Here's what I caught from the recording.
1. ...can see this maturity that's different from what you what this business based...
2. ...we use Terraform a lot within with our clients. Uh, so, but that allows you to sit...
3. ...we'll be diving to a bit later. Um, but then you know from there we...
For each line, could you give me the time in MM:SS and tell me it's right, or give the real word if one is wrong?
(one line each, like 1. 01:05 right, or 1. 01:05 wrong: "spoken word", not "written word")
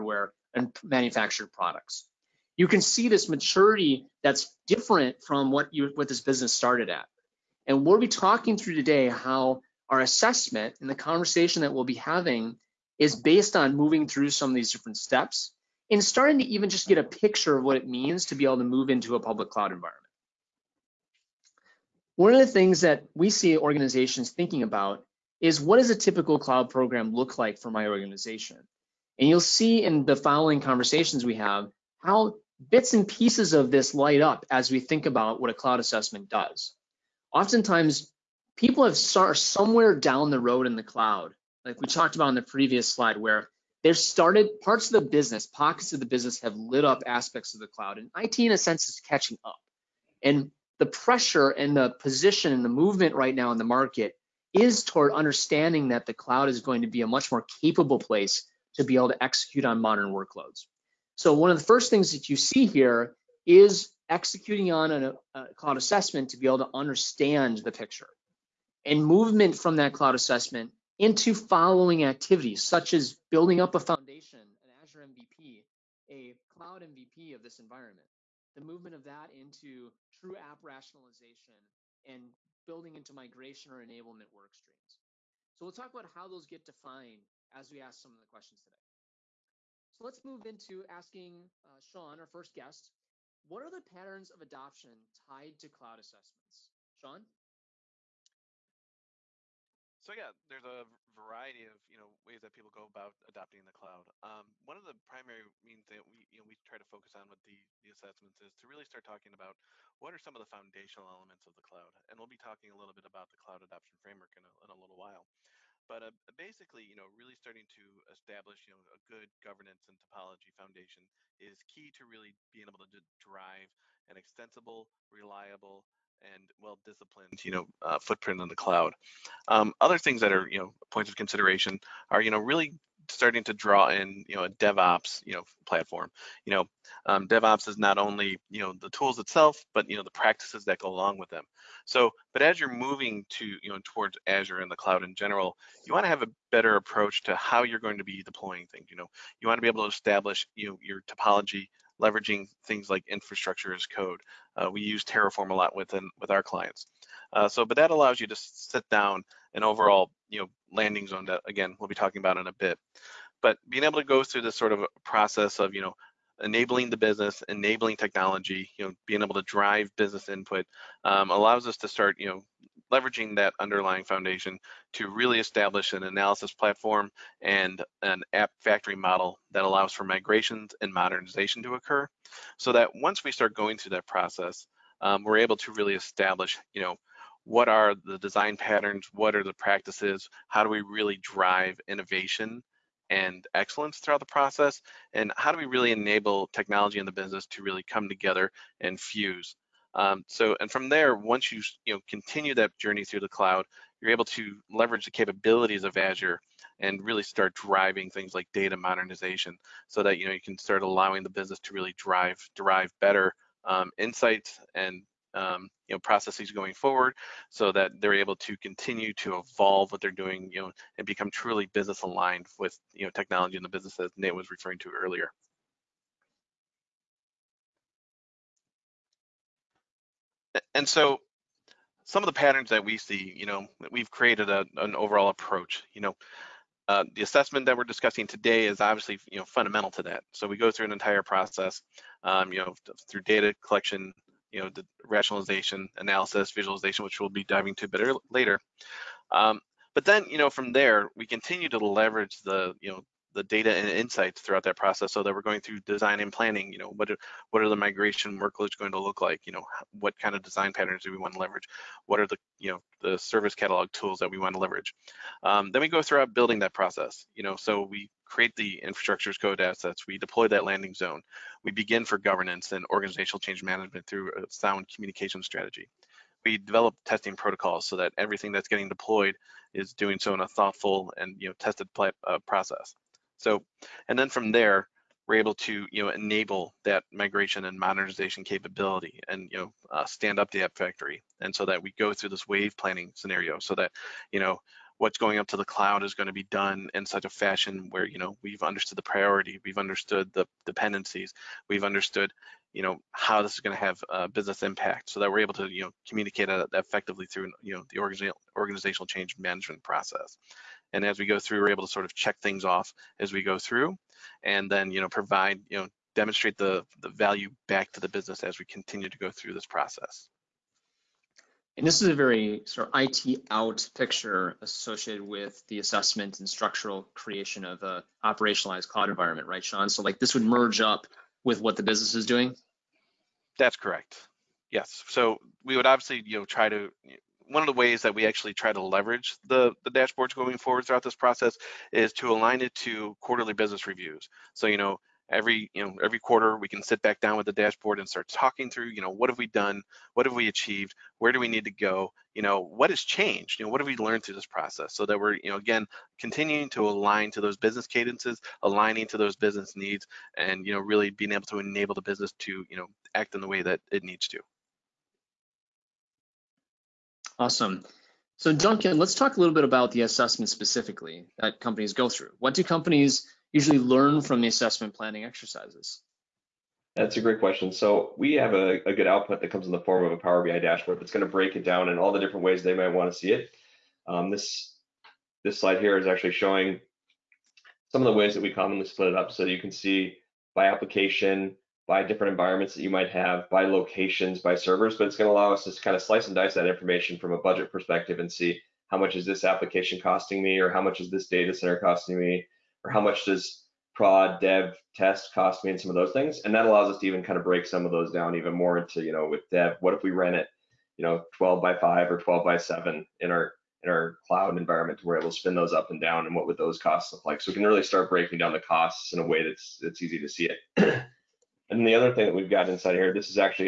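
1. 00:02 wrong: "started", not "based"
2. 02:34 right
3. 04:07 right.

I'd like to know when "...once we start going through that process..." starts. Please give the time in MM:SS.
03:02.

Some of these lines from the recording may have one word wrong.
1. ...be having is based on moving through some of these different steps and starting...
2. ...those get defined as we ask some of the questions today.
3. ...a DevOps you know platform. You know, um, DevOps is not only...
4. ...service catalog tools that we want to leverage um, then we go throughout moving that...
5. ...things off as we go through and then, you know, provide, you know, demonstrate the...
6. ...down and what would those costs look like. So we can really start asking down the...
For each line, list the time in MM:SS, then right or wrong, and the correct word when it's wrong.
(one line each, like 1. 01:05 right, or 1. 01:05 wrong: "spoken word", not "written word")
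1. 00:11 right
2. 01:26 right
3. 02:14 right
4. 04:23 wrong: "building", not "moving"
5. 05:12 right
6. 06:56 wrong: "breaking", not "asking".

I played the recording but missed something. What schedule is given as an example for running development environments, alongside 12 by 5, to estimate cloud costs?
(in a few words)
12 by 7.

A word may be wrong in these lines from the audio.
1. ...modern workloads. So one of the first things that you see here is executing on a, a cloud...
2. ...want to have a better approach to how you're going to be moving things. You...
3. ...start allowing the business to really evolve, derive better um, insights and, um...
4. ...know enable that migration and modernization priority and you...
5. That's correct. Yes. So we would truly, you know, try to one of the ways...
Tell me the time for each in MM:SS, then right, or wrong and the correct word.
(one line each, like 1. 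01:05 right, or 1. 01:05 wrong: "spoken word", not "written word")
1. 00:59 right
2. 02:25 wrong: "deploying", not "moving"
3. 03:30 wrong: "drive", not "evolve"
4. 04:46 wrong: "capability", not "priority"
5. 05:33 wrong: "obviously", not "truly".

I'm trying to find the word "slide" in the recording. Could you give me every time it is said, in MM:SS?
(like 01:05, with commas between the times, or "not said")
00:42, 06:25.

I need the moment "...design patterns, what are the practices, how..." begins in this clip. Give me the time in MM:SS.
03:08.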